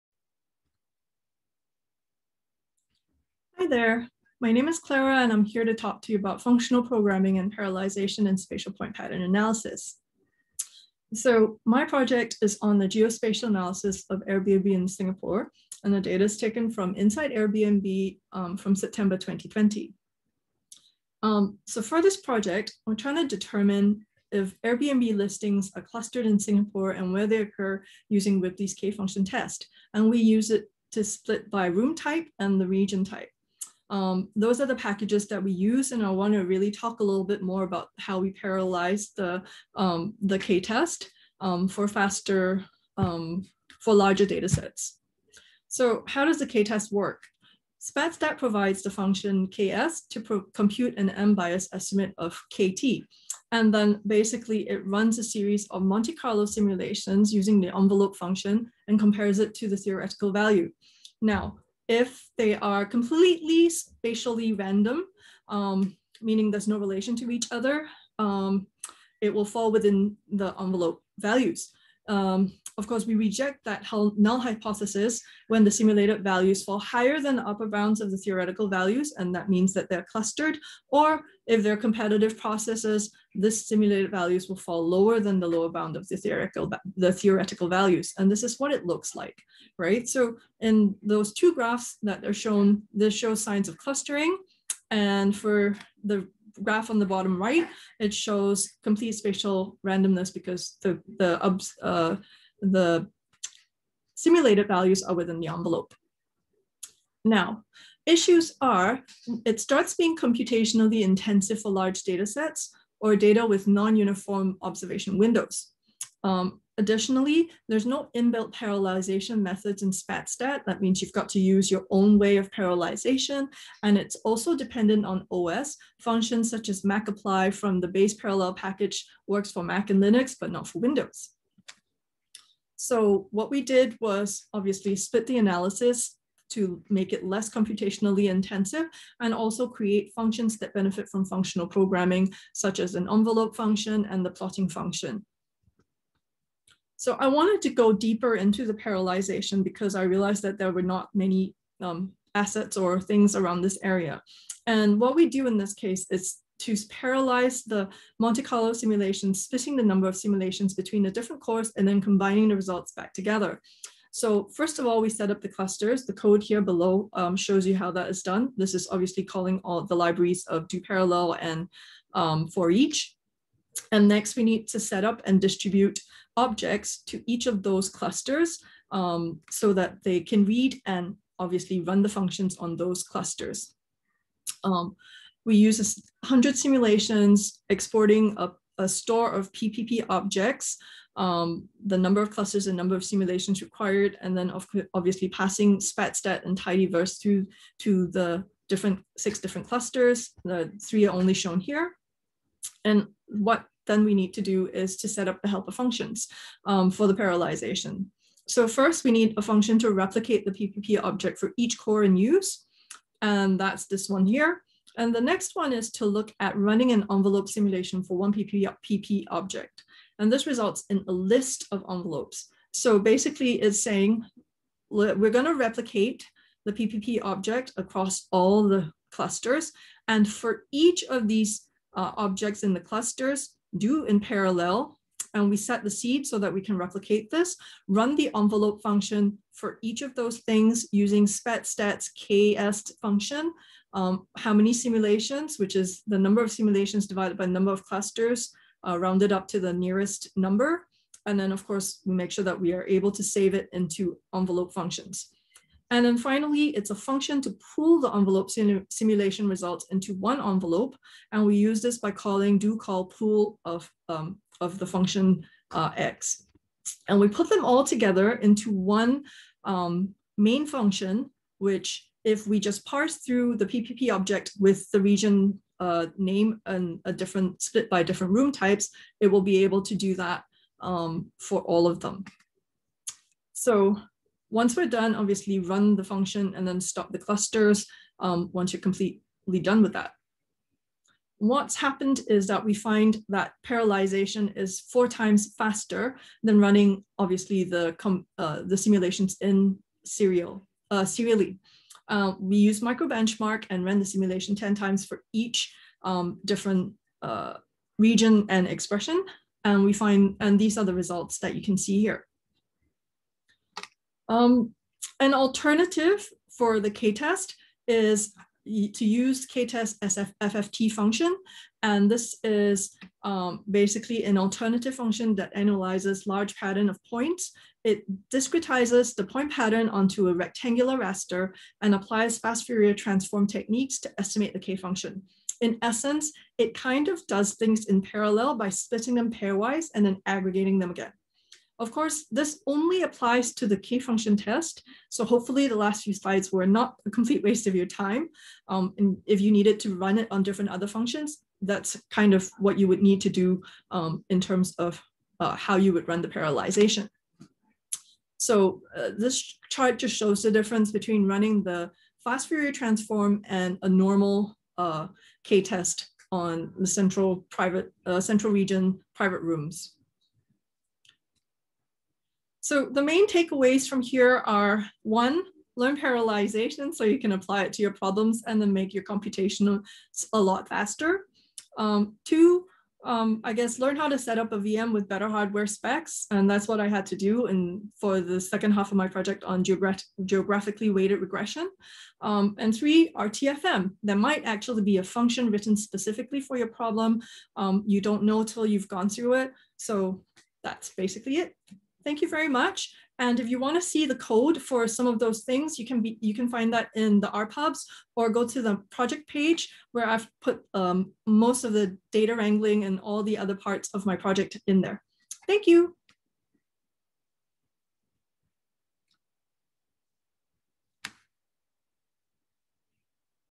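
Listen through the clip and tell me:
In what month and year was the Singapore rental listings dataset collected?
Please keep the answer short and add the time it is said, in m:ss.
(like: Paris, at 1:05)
September 2020, at 0:18.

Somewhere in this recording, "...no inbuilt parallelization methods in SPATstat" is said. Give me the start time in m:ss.
1:57.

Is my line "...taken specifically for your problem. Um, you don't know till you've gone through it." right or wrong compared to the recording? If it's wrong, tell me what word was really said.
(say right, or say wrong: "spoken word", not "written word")
wrong: "written", not "taken".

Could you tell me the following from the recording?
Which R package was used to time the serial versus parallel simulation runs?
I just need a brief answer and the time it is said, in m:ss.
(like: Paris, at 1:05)
microbenchmark, at 5:02.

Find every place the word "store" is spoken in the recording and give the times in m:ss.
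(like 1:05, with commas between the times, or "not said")
3:08.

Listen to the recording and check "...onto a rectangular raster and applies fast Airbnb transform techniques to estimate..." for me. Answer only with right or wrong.
wrong.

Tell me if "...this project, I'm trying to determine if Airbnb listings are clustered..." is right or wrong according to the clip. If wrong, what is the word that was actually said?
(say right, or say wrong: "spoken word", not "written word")
right.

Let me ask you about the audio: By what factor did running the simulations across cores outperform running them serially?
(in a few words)
4 times.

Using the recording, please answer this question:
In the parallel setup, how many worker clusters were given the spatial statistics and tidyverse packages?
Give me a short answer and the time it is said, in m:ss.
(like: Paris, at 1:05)
6, at 3:19.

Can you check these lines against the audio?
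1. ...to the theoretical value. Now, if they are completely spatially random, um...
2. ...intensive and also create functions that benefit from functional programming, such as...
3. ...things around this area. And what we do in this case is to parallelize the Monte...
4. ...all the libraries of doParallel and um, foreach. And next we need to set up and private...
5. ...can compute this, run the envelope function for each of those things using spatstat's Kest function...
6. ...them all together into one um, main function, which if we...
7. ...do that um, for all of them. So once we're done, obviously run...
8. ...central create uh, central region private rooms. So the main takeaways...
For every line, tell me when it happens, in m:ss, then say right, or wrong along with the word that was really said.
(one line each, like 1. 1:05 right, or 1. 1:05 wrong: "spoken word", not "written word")
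1. 0:59 right
2. 2:18 right
3. 2:33 right
4. 2:49 wrong: "distribute", not "private"
5. 3:56 wrong: "replicate", not "compute"
6. 4:27 right
7. 4:39 right
8. 6:06 wrong: "private", not "create".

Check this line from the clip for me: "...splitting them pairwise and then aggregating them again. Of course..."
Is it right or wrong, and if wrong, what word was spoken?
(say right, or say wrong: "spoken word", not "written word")
right.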